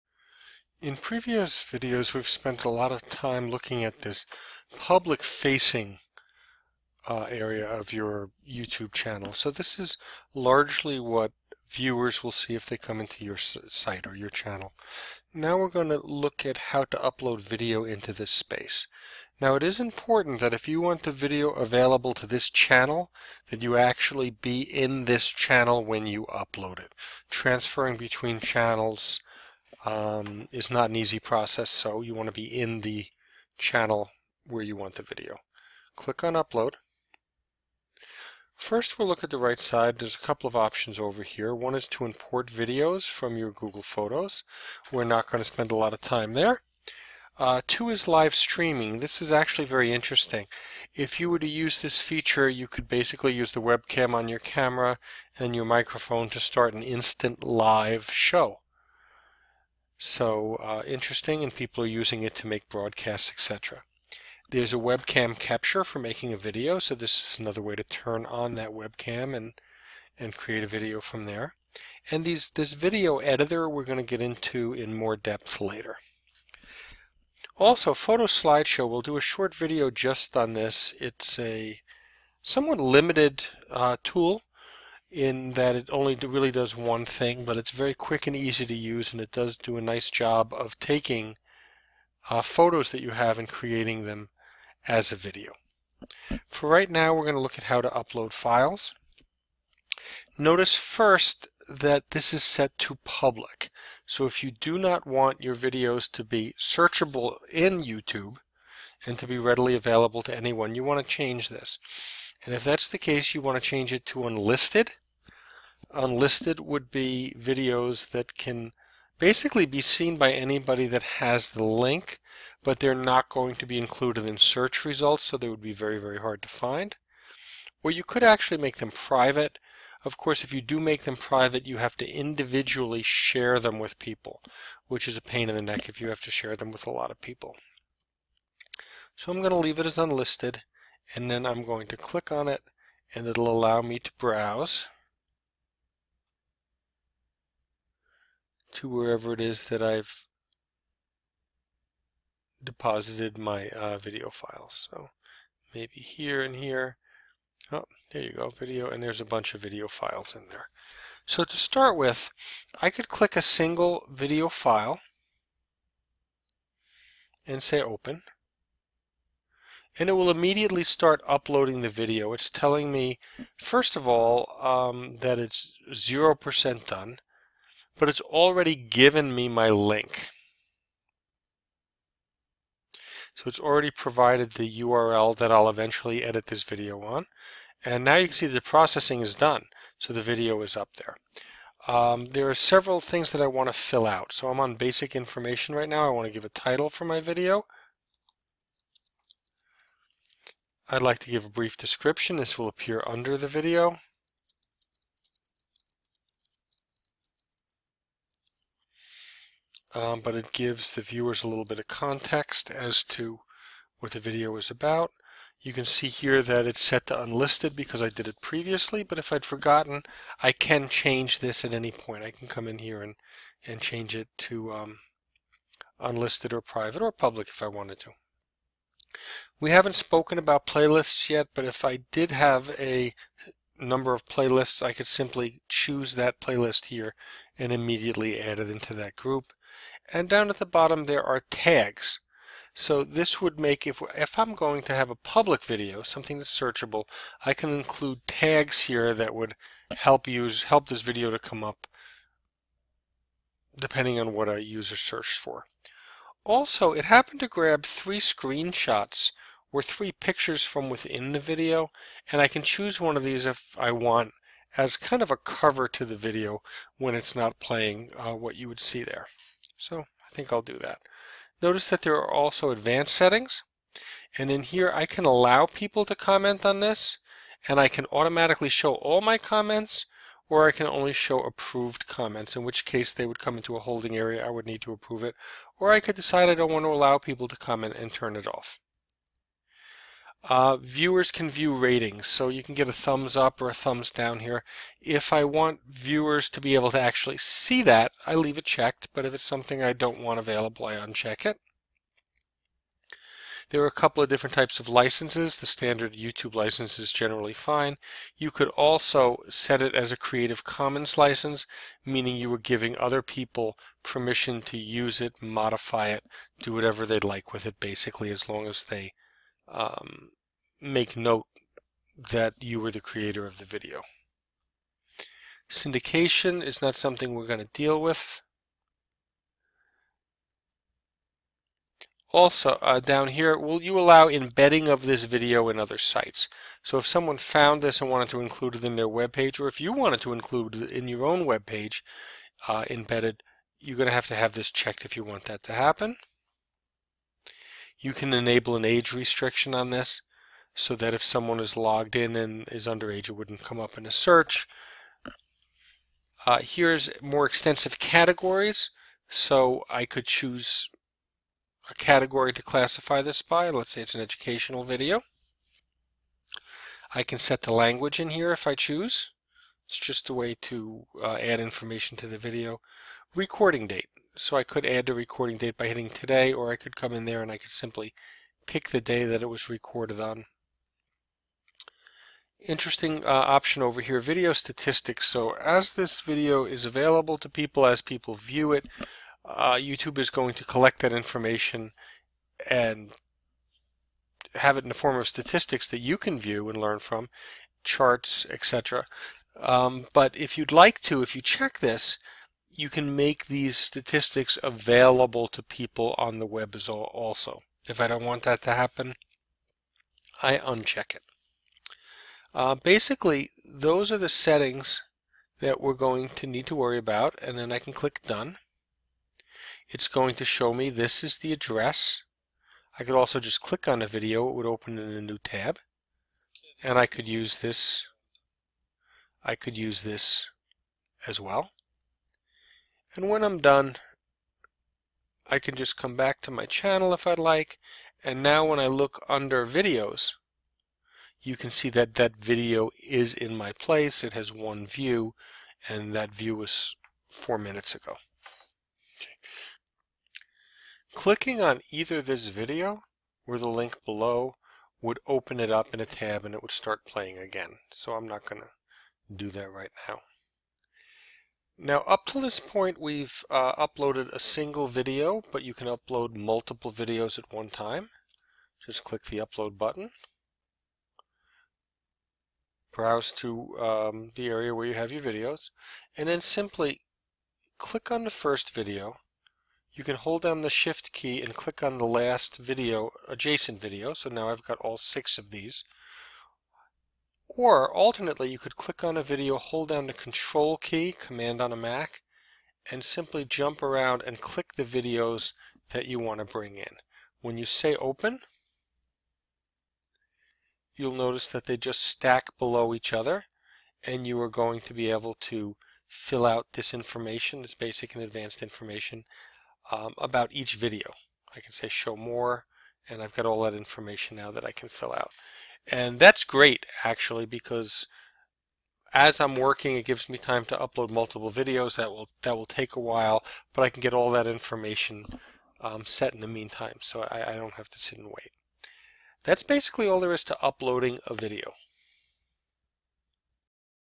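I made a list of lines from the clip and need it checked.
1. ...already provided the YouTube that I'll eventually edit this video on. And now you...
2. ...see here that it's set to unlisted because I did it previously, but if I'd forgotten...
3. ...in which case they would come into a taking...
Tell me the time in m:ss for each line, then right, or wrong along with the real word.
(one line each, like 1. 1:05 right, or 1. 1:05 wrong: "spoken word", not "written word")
1. 3:03 wrong: "URL", not "YouTube"
2. 3:35 right
3. 4:42 wrong: "holding", not "taking".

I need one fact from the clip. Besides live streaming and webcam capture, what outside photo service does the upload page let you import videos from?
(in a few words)
Google Photos.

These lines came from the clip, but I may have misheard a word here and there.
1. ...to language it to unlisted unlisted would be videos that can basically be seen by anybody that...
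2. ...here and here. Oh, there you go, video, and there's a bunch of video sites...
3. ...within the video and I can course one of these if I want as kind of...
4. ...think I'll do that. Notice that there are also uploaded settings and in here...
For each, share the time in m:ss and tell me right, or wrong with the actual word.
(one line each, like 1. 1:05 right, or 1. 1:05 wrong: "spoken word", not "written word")
1. 1:53 wrong: "change", not "language"
2. 2:36 wrong: "files", not "sites"
3. 4:20 wrong: "choose", not "course"
4. 4:30 wrong: "advanced", not "uploaded".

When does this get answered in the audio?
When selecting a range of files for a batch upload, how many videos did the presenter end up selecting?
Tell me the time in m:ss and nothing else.
8:04.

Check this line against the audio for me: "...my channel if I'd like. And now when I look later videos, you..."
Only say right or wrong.
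wrong.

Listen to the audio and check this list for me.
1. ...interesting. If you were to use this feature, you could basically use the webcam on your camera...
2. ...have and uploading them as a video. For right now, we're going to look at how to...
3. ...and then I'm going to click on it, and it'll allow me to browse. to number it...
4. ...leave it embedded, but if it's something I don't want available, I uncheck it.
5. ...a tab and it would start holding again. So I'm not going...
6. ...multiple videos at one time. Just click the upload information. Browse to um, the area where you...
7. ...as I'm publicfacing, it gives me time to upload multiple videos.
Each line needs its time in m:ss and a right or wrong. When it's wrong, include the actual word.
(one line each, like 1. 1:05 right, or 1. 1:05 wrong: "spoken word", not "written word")
1. 0:49 right
2. 1:33 wrong: "creating", not "uploading"
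3. 2:21 wrong: "wherever", not "number"
4. 4:58 wrong: "checked", not "embedded"
5. 7:35 wrong: "playing", not "holding"
6. 7:46 wrong: "button", not "information"
7. 8:39 wrong: "working", not "publicfacing".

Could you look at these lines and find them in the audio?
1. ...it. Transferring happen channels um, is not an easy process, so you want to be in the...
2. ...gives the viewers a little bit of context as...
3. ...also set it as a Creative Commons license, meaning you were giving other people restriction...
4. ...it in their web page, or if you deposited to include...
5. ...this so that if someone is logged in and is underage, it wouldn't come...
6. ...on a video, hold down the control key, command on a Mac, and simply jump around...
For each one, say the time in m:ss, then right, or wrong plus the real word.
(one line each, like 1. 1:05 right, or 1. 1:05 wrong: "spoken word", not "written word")
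1. 0:26 wrong: "between", not "happen"
2. 3:30 right
3. 5:08 wrong: "permission", not "restriction"
4. 5:38 wrong: "wanted", not "deposited"
5. 5:49 right
6. 8:09 right.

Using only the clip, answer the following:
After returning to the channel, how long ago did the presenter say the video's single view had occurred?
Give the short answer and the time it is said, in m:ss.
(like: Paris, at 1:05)
4 minutes, at 7:27.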